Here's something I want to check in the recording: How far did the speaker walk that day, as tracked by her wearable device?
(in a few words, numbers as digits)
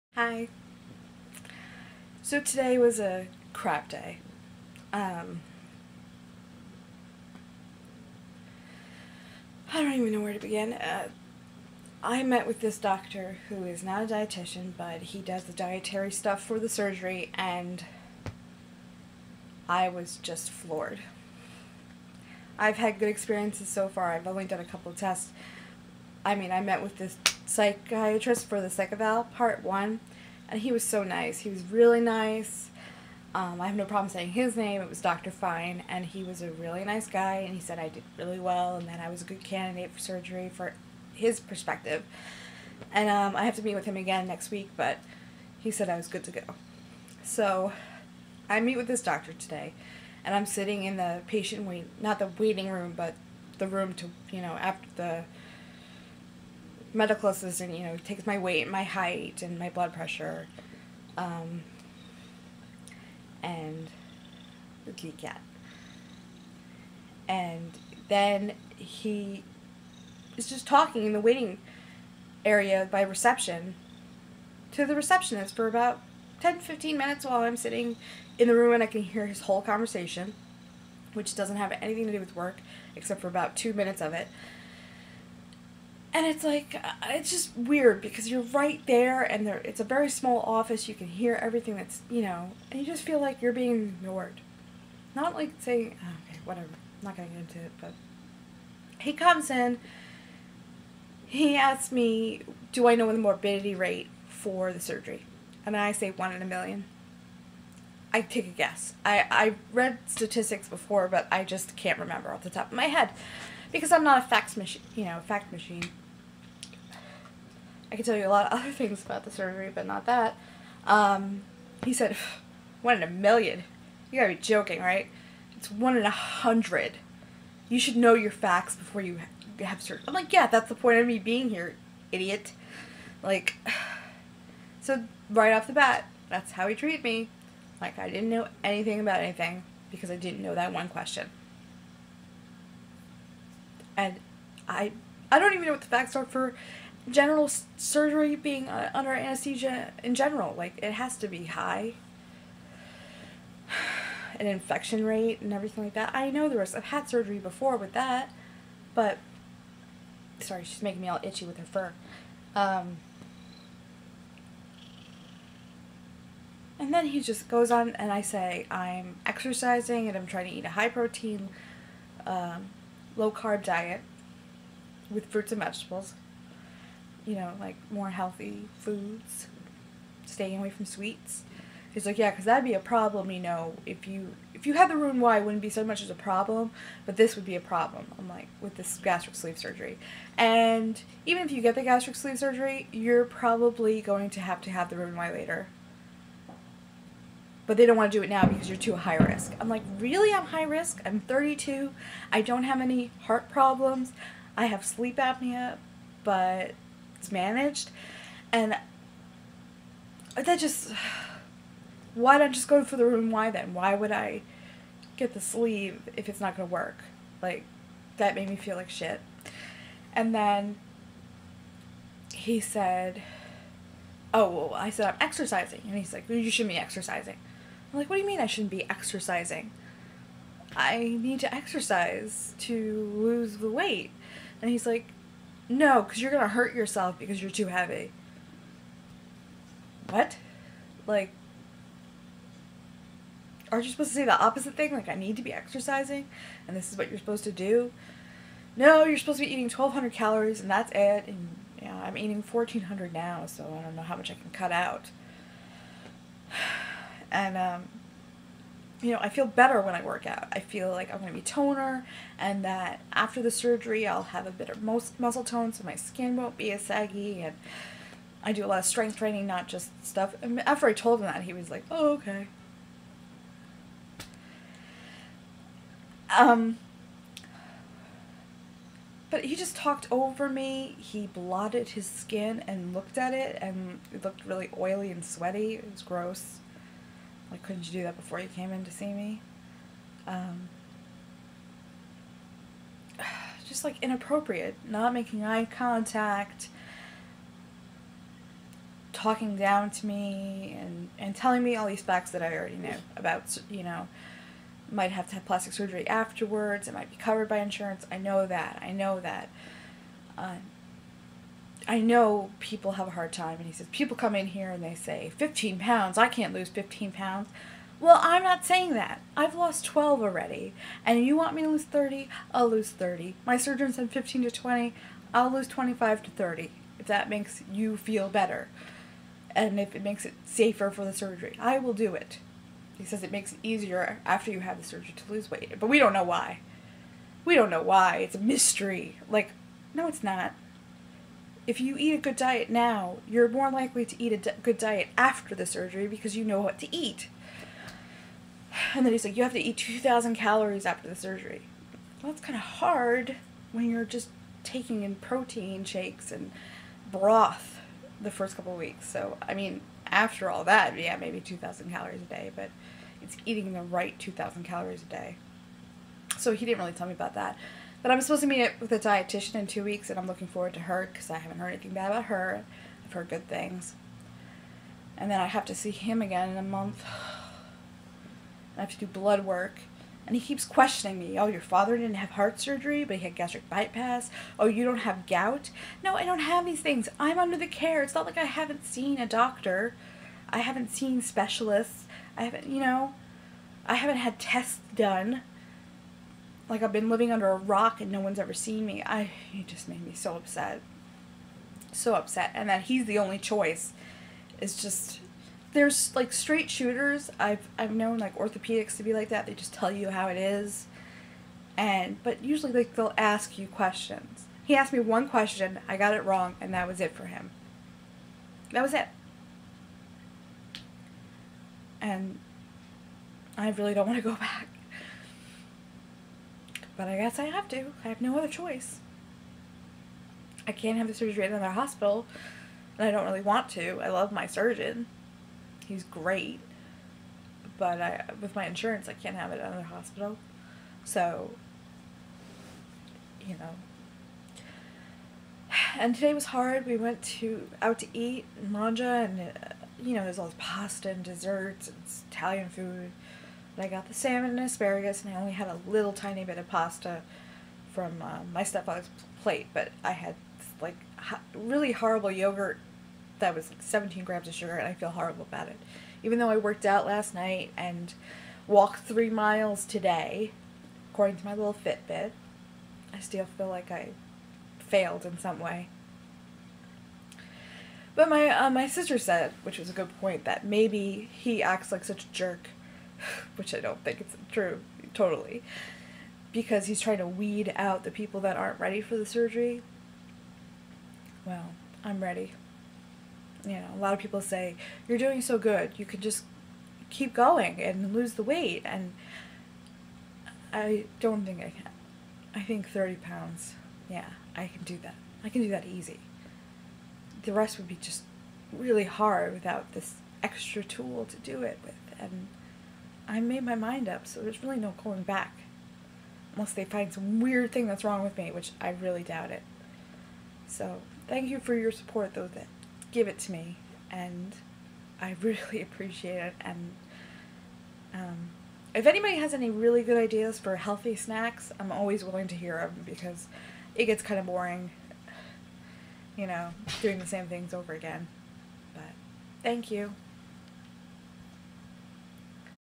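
3 miles.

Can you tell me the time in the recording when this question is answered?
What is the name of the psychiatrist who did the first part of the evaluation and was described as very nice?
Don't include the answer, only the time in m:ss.
0:34.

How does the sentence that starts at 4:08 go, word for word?
No, you're supposed to be eating 1,200 calories, and that's it.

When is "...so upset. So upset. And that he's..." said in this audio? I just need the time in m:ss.
6:40.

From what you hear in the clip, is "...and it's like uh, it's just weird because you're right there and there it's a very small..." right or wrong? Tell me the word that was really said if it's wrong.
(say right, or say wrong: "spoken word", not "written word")
right.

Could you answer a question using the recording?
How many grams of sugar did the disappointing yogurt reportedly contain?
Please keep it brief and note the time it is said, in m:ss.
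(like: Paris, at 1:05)
17, at 7:43.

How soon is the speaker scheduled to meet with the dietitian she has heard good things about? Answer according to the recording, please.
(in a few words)
2 weeks.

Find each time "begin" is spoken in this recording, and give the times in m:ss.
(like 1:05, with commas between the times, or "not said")
0:10.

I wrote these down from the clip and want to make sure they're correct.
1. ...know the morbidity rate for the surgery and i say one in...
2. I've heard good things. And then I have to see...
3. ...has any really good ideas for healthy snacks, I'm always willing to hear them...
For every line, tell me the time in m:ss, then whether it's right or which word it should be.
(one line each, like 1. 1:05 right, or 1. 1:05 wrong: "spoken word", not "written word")
1. 1:42 right
2. 6:13 right
3. 8:49 right.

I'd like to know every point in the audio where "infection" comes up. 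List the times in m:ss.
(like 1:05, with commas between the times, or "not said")
2:34.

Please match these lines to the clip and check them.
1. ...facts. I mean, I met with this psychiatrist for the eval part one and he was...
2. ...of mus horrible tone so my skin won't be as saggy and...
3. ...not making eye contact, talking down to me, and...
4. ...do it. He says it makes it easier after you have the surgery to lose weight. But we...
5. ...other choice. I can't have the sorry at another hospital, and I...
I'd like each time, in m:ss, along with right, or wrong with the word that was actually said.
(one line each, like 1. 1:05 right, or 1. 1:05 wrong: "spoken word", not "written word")
1. 0:24 wrong: "tests", not "facts"
2. 4:24 wrong: "muscle", not "horrible"
3. 4:54 right
4. 5:31 right
5. 7:08 wrong: "surgery", not "sorry".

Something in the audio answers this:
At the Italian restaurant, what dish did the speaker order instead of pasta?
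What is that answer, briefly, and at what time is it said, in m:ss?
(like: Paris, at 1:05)
Salmon and asparagus, at 7:34.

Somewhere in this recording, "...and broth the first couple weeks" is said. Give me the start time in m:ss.
5:56.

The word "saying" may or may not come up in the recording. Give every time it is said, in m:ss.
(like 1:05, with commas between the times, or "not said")
0:34, 1:35, 5:18.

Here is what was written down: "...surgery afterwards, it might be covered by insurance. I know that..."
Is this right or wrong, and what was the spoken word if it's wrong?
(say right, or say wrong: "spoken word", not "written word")
right.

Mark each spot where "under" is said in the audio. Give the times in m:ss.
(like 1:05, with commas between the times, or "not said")
2:28, 6:27, 6:37.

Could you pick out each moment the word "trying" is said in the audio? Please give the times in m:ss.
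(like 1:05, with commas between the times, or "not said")
2:50, 8:07.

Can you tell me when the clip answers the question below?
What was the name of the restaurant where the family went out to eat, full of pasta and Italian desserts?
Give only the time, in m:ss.
7:28.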